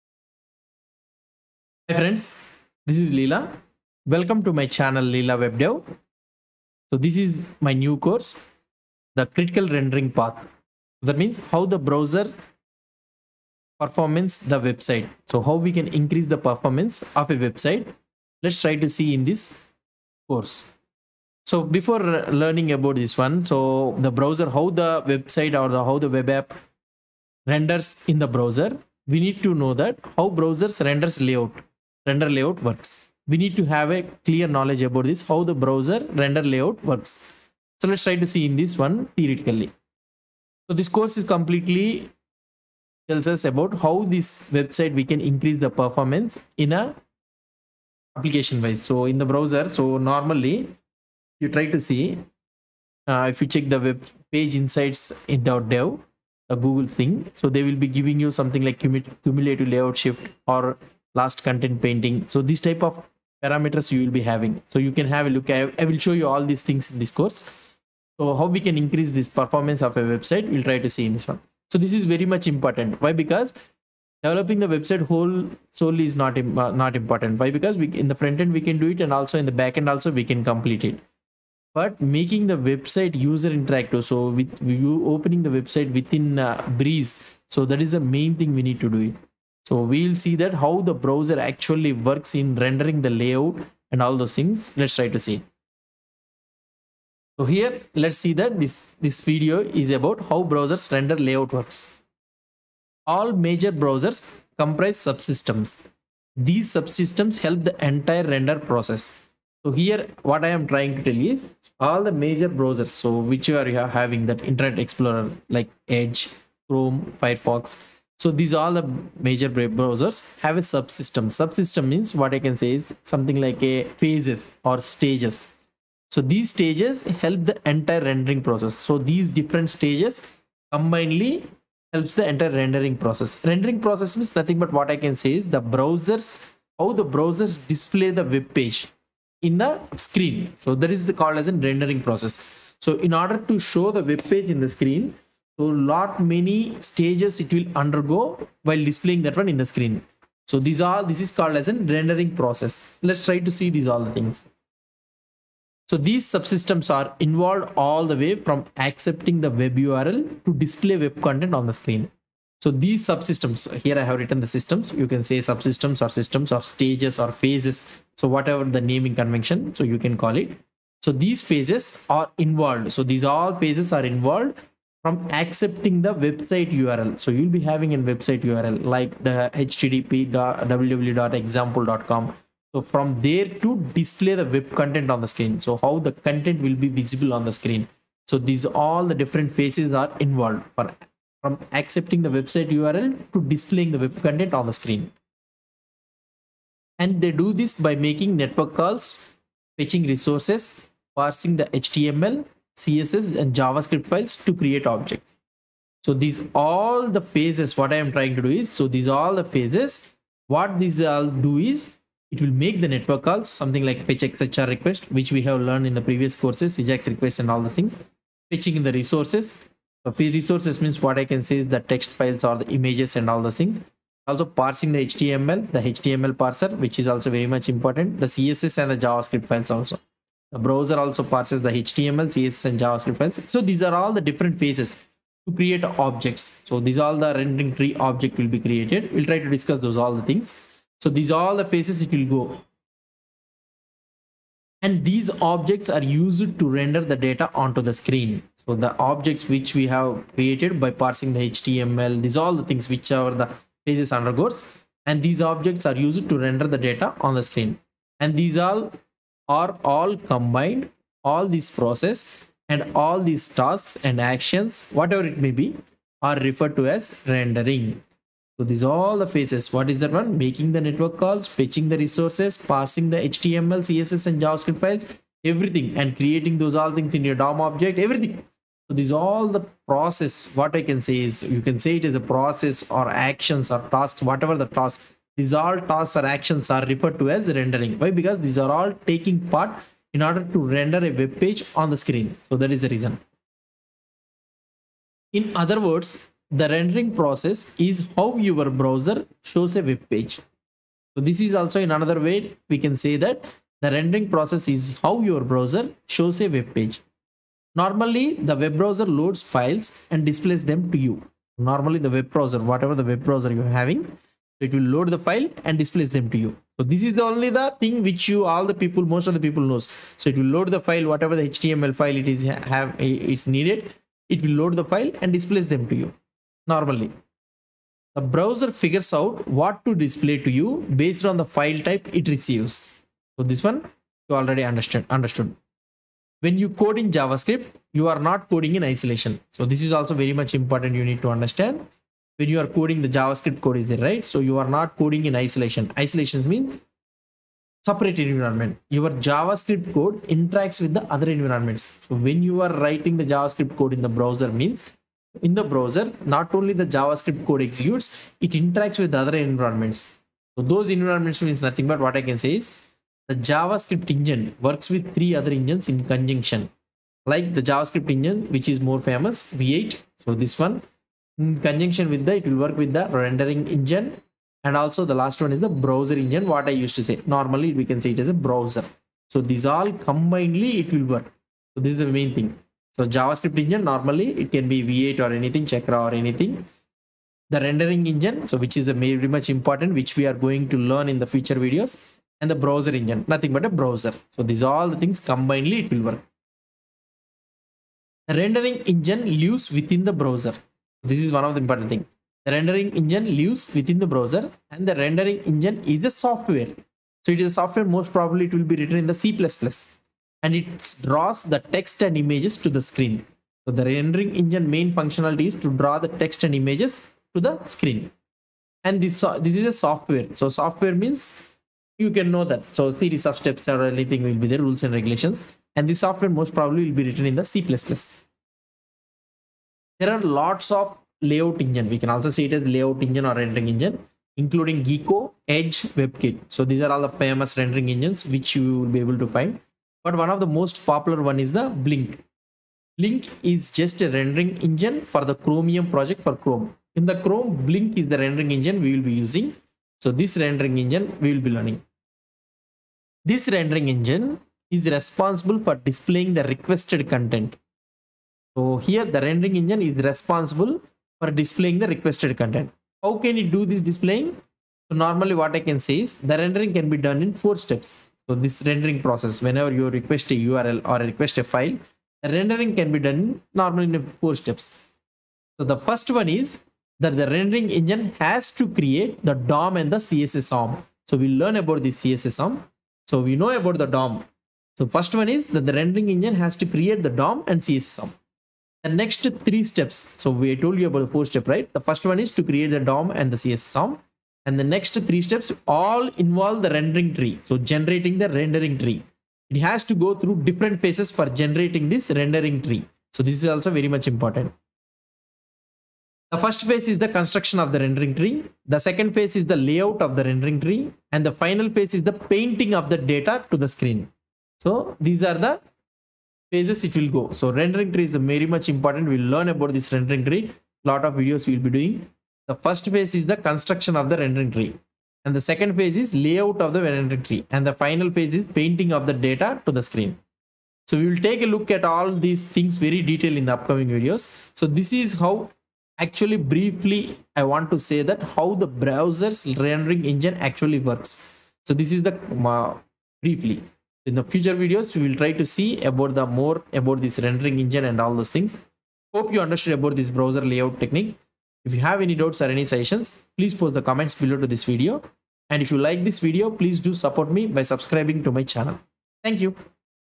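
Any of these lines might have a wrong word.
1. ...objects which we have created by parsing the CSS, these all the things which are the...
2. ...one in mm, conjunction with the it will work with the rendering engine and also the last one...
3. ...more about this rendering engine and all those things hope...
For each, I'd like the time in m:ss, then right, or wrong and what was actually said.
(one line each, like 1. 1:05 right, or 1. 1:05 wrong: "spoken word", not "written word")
1. 4:08 wrong: "HTML", not "CSS"
2. 6:10 right
3. 9:06 right.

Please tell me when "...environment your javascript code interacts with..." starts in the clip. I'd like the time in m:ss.
5:48.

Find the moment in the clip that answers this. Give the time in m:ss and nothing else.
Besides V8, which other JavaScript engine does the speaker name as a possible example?
6:25.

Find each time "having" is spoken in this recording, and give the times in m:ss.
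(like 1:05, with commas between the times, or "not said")
1:04, 1:53, 2:57, 5:13.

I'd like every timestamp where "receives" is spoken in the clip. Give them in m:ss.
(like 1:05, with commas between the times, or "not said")
5:32.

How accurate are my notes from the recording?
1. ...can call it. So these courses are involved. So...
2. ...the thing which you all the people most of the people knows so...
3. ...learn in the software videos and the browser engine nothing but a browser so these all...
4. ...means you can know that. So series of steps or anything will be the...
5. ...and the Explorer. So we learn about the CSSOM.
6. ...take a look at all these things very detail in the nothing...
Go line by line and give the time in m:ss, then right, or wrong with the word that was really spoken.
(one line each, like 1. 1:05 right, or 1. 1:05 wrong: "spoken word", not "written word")
1. 2:49 wrong: "phases", not "courses"
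2. 5:17 right
3. 6:30 wrong: "future", not "software"
4. 7:00 right
5. 7:59 wrong: "CSSOM", not "Explorer"
6. 8:51 wrong: "upcoming", not "nothing".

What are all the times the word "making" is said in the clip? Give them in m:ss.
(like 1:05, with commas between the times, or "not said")
1:21, 3:17, 4:30.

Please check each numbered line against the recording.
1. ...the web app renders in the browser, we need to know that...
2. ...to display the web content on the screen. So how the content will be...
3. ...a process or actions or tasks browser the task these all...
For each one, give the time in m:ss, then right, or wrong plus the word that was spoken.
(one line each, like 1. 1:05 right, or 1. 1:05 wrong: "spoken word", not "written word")
1. 0:25 right
2. 3:03 right
3. 4:42 wrong: "whatever", not "browser".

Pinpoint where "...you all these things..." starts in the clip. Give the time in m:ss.
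1:06.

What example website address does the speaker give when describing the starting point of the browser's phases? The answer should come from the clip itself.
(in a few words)
www.example.com.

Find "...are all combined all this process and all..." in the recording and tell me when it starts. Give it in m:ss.
4:19.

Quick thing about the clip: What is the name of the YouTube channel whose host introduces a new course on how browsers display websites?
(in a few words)
Leela Web Dev.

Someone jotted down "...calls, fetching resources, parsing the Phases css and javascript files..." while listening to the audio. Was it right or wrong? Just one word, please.
wrong.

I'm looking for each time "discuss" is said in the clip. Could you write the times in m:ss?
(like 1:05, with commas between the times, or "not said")
3:59.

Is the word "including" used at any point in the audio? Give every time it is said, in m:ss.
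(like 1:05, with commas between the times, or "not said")
7:14.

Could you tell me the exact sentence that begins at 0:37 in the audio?
So let's try to see in this one theoretically.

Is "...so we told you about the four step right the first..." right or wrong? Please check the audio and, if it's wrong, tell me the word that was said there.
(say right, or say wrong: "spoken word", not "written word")
right.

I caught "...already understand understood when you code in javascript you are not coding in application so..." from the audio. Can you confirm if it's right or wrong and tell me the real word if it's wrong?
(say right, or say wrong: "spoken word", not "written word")
wrong: "isolation", not "application".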